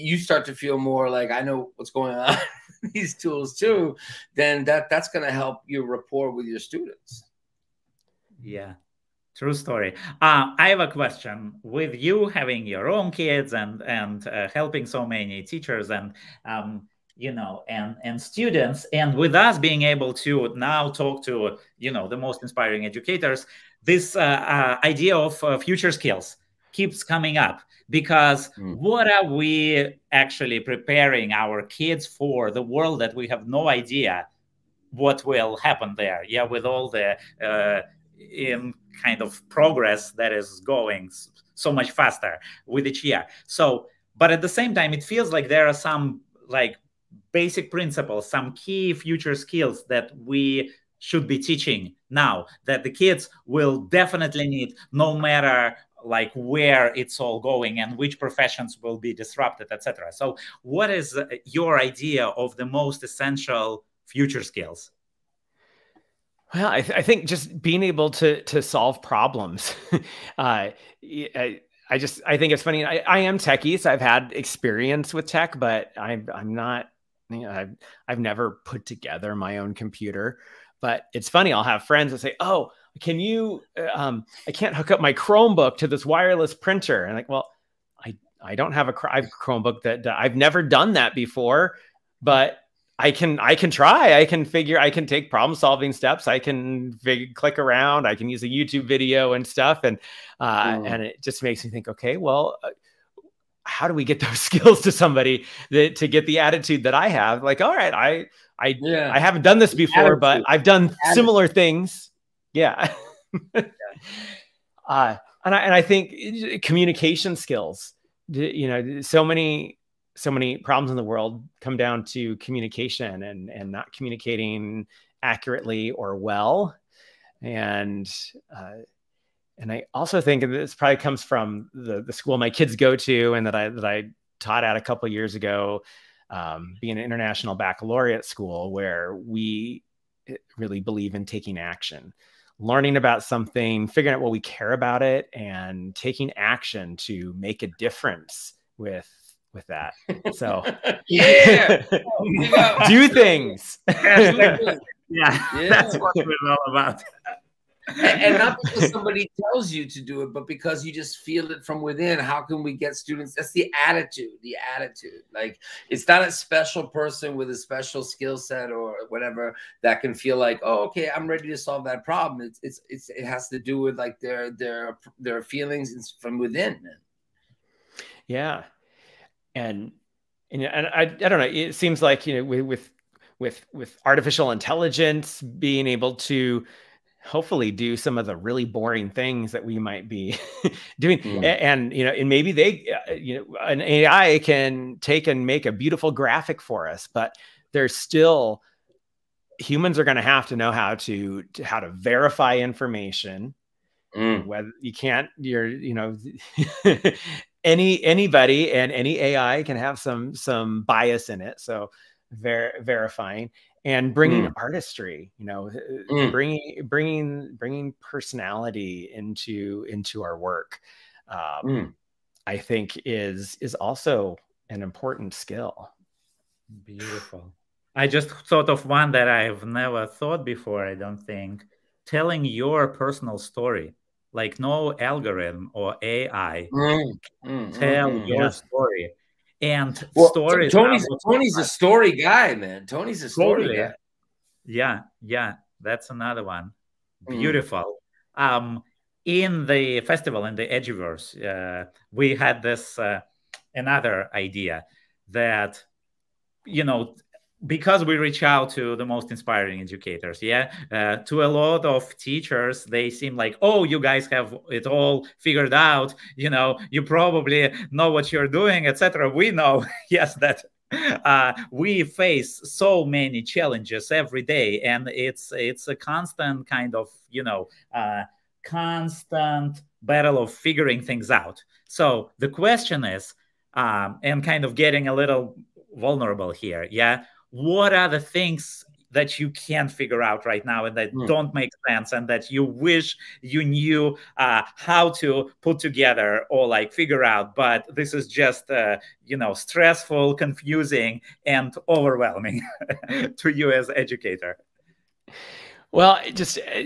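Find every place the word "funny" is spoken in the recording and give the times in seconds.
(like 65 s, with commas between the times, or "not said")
72 s, 81 s.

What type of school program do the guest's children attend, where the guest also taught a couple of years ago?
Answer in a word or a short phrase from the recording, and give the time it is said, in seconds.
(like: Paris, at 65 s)
international baccalaureate, at 137 s.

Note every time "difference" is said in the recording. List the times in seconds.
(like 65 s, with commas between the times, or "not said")
147 s.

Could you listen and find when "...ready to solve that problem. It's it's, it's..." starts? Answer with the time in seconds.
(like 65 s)
171 s.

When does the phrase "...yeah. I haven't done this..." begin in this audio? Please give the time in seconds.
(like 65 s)
108 s.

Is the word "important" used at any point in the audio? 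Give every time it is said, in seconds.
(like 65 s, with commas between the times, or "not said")
224 s.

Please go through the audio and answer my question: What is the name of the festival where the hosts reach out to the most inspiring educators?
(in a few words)
Eduverse.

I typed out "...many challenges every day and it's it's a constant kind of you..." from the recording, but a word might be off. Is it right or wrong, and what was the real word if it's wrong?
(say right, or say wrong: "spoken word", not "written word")
right.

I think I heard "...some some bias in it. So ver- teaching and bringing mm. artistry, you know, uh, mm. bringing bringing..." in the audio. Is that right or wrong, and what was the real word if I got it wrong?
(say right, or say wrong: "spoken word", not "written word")
wrong: "verifying", not "teaching".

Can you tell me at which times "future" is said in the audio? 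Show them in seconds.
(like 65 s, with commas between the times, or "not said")
25 s, 48 s, 64 s.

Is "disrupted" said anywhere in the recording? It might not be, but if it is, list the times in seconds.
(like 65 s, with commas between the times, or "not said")
59 s.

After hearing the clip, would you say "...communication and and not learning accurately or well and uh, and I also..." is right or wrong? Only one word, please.
wrong.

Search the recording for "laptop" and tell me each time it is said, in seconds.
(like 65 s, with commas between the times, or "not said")
not said.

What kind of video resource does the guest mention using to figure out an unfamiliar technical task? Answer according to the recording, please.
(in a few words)
YouTube video.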